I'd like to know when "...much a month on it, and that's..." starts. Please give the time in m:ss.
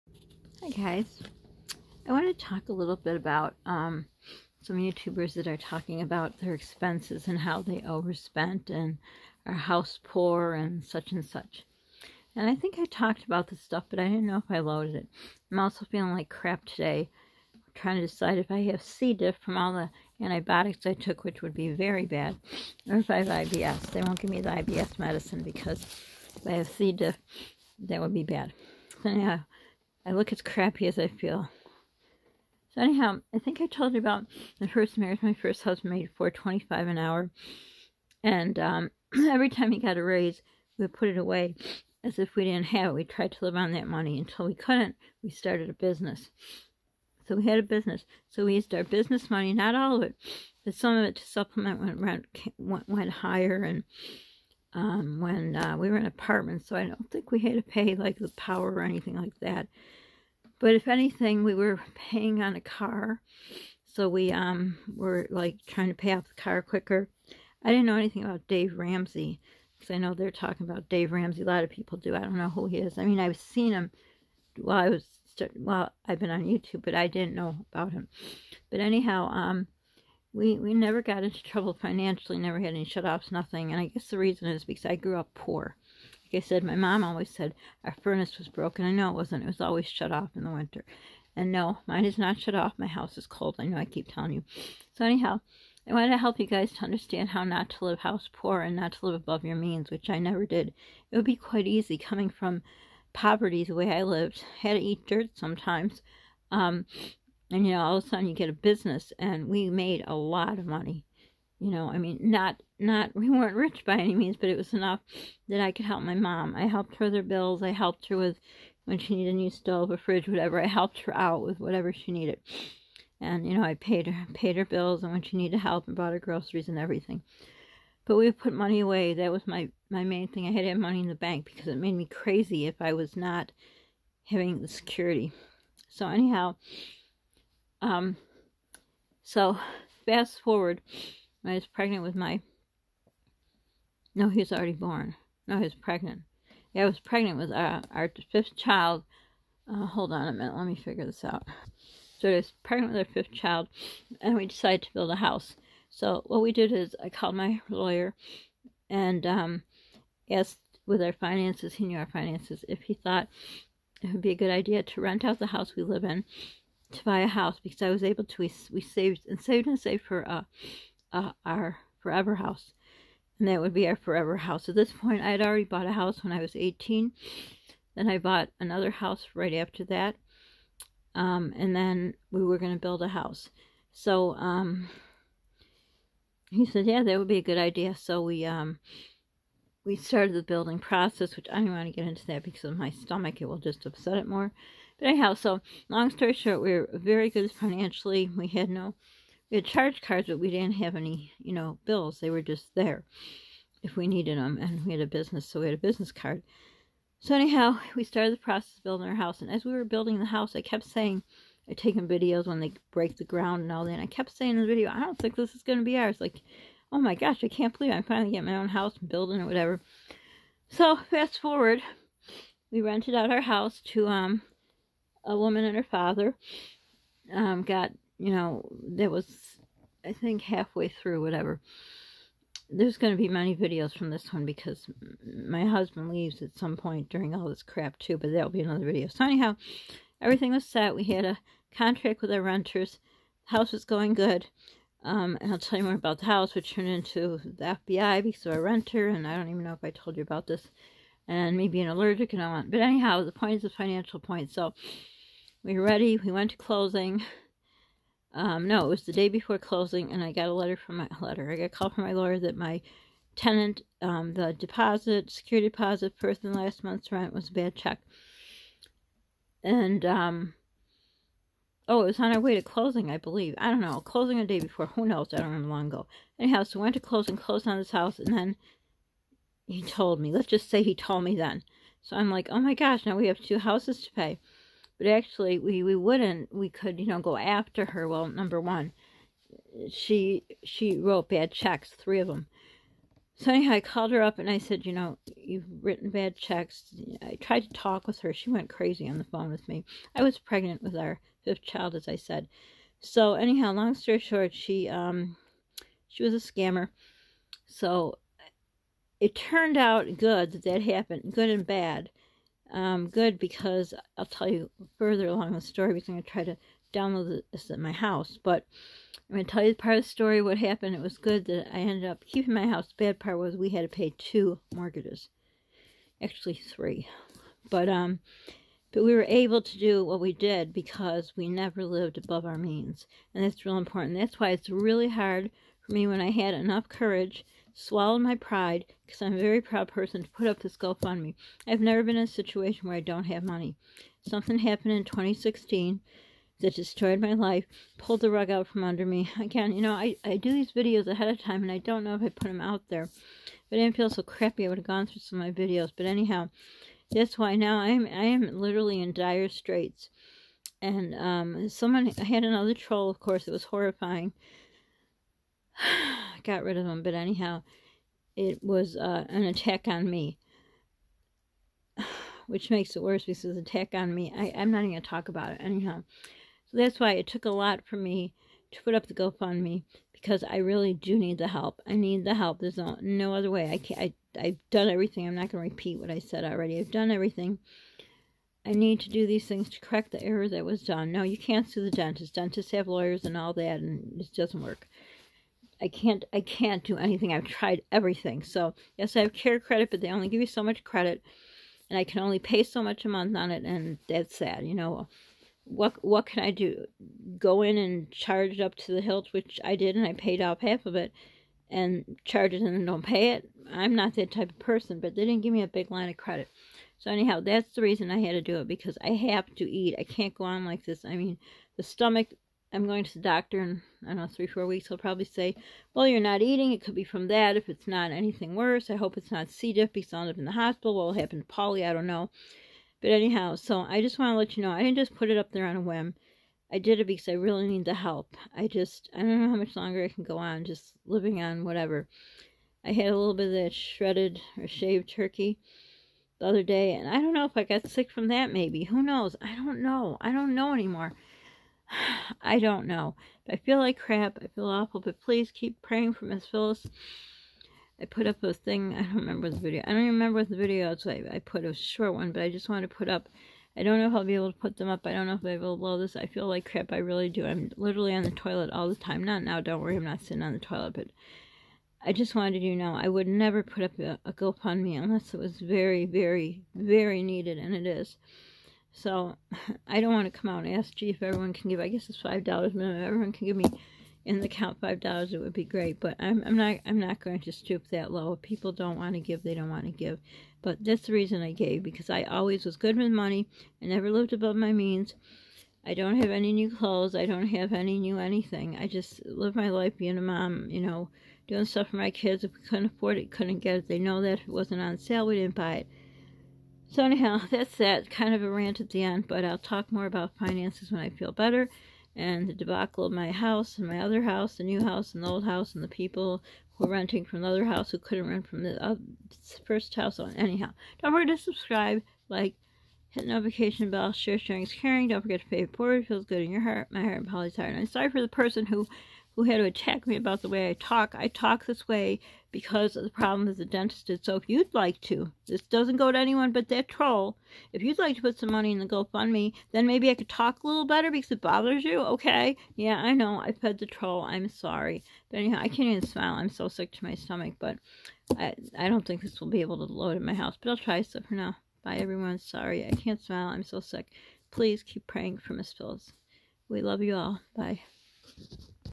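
6:42.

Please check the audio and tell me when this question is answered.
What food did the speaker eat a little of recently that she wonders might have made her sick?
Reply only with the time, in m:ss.
7:24.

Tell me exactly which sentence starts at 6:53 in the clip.
I'm not that type of person, but they didn't give me a big line of credit.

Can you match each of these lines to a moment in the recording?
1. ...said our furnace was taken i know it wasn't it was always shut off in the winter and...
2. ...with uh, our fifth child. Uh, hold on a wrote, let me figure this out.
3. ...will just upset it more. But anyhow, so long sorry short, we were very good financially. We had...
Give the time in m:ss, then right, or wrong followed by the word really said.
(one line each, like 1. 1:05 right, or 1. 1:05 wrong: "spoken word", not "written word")
1. 1:27 wrong: "broken", not "taken"
2. 2:27 wrong: "minute", not "wrote"
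3. 3:13 wrong: "story", not "sorry".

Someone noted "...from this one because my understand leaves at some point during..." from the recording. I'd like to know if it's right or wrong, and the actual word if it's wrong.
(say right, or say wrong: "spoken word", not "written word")
wrong: "husband", not "understand".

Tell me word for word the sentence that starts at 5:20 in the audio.
It was good that I ended up keeping my house.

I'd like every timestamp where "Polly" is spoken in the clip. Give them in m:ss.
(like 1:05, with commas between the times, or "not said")
7:11, 8:47.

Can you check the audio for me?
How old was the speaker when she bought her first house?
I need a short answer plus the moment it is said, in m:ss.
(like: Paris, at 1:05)
18, at 2:56.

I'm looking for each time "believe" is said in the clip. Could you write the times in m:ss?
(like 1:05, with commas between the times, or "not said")
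3:37, 4:33.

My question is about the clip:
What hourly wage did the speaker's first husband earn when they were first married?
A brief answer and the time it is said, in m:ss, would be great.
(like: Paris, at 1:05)
$4.25, at 0:36.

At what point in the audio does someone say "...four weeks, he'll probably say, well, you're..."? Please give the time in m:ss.
7:04.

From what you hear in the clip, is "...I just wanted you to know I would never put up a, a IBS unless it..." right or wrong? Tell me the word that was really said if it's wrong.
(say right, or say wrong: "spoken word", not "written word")
wrong: "GoFundMe", not "IBS".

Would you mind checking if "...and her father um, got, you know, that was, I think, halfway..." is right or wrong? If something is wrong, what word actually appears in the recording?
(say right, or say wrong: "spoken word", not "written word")
right.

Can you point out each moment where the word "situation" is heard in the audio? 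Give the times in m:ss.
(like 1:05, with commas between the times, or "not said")
5:42.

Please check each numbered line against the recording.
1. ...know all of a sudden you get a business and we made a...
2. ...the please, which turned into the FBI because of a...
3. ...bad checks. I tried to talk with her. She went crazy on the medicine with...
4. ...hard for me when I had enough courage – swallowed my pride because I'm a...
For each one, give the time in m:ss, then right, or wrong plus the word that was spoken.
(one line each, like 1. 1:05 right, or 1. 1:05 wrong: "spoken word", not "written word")
1. 1:47 right
2. 4:06 wrong: "house", not "please"
3. 4:56 wrong: "phone", not "medicine"
4. 5:35 right.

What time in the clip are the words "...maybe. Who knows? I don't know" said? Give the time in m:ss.
7:28.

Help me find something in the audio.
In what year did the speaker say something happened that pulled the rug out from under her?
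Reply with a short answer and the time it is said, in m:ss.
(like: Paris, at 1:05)
2016, at 5:45.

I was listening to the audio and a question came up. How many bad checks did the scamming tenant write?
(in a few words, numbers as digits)
3.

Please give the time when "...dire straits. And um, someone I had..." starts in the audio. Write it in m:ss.
5:59.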